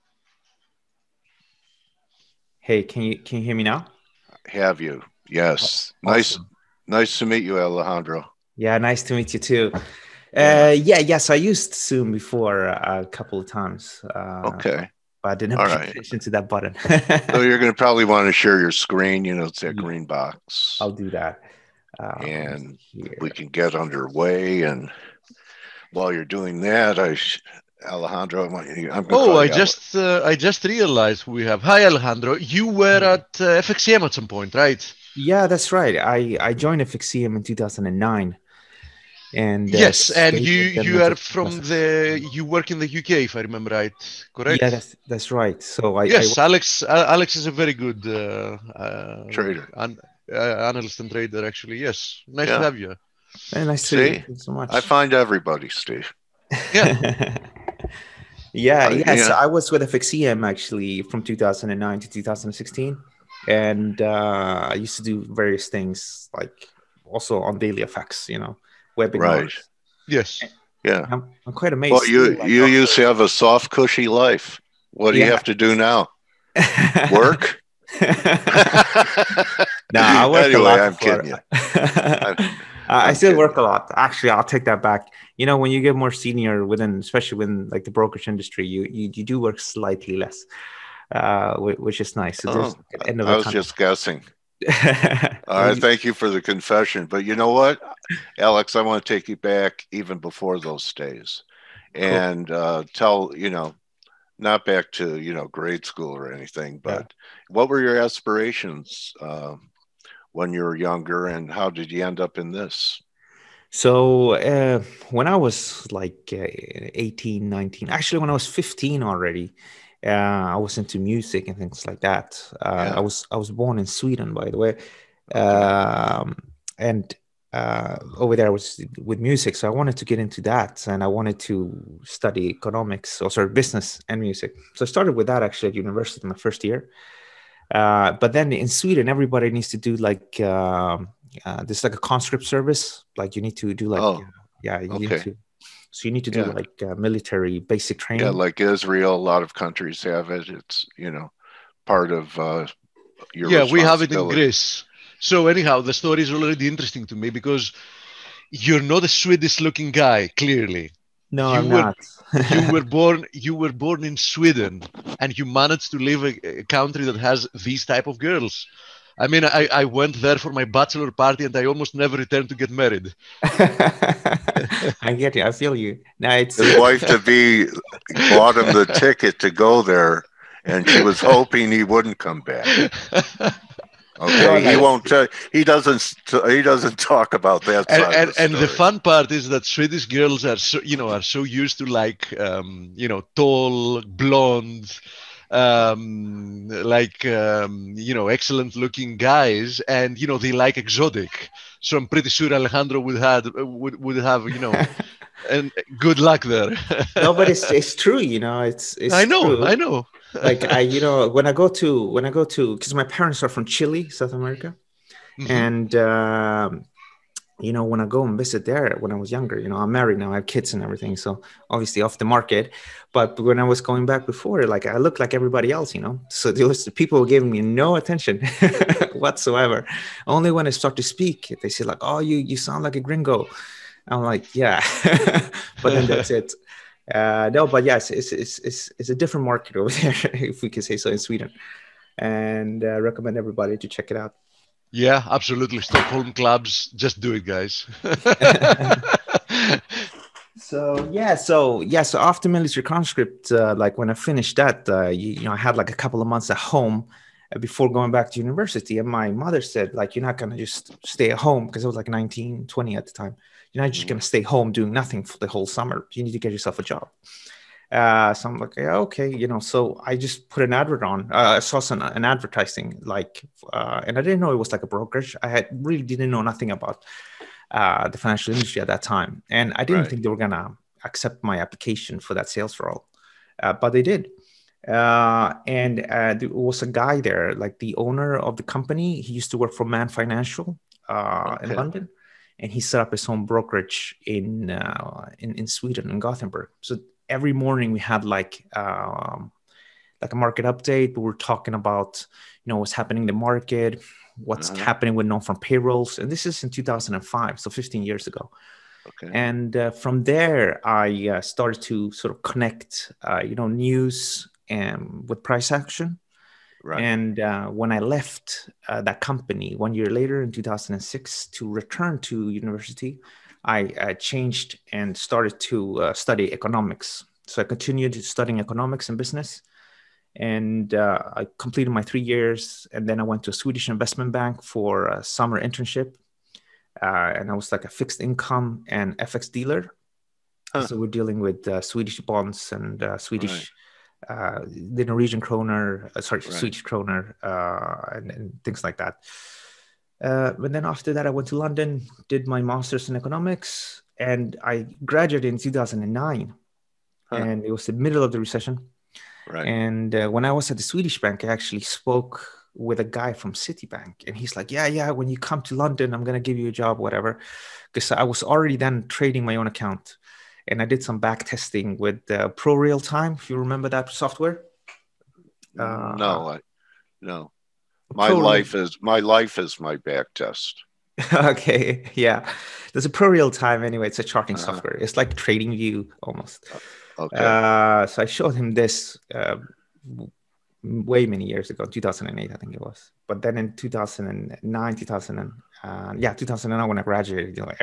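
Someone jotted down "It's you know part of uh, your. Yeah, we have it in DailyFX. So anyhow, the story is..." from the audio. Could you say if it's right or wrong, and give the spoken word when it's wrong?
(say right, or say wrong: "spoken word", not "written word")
wrong: "Greece", not "DailyFX".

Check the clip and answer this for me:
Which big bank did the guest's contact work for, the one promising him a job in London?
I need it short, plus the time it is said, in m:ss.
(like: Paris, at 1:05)
Citibank, at 6:03.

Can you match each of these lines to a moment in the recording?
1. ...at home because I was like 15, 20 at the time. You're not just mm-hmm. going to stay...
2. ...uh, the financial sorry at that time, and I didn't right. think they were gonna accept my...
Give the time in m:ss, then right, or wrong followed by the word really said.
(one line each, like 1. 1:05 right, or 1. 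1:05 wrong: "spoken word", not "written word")
1. 4:21 wrong: "19", not "15"
2. 4:37 wrong: "industry", not "sorry".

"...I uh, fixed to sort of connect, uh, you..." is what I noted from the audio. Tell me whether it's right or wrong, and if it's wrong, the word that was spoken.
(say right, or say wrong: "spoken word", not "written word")
wrong: "started", not "fixed".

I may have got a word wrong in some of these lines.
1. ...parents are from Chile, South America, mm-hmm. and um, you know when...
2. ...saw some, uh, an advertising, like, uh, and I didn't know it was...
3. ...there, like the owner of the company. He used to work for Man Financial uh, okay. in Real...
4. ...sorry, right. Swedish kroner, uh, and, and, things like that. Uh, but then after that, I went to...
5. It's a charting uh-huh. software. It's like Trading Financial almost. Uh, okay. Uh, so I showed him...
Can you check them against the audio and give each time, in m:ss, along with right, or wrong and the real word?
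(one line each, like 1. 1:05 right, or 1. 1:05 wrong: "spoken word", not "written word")
1. 3:33 right
2. 4:31 right
3. 4:47 wrong: "London", not "Real"
4. 5:46 right
5. 6:24 wrong: "View", not "Financial".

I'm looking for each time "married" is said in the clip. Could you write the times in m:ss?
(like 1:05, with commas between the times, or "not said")
2:52, 3:39.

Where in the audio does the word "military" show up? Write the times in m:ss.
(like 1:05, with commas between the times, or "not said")
2:26, 4:12.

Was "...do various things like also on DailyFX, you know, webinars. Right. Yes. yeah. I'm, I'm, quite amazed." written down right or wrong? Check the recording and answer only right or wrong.
right.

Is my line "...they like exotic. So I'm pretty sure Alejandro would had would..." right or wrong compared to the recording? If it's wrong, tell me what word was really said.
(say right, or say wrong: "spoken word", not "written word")
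right.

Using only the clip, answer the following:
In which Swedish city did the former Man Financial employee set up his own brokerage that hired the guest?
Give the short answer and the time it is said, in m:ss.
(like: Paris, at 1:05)
Gothenburg, at 4:56.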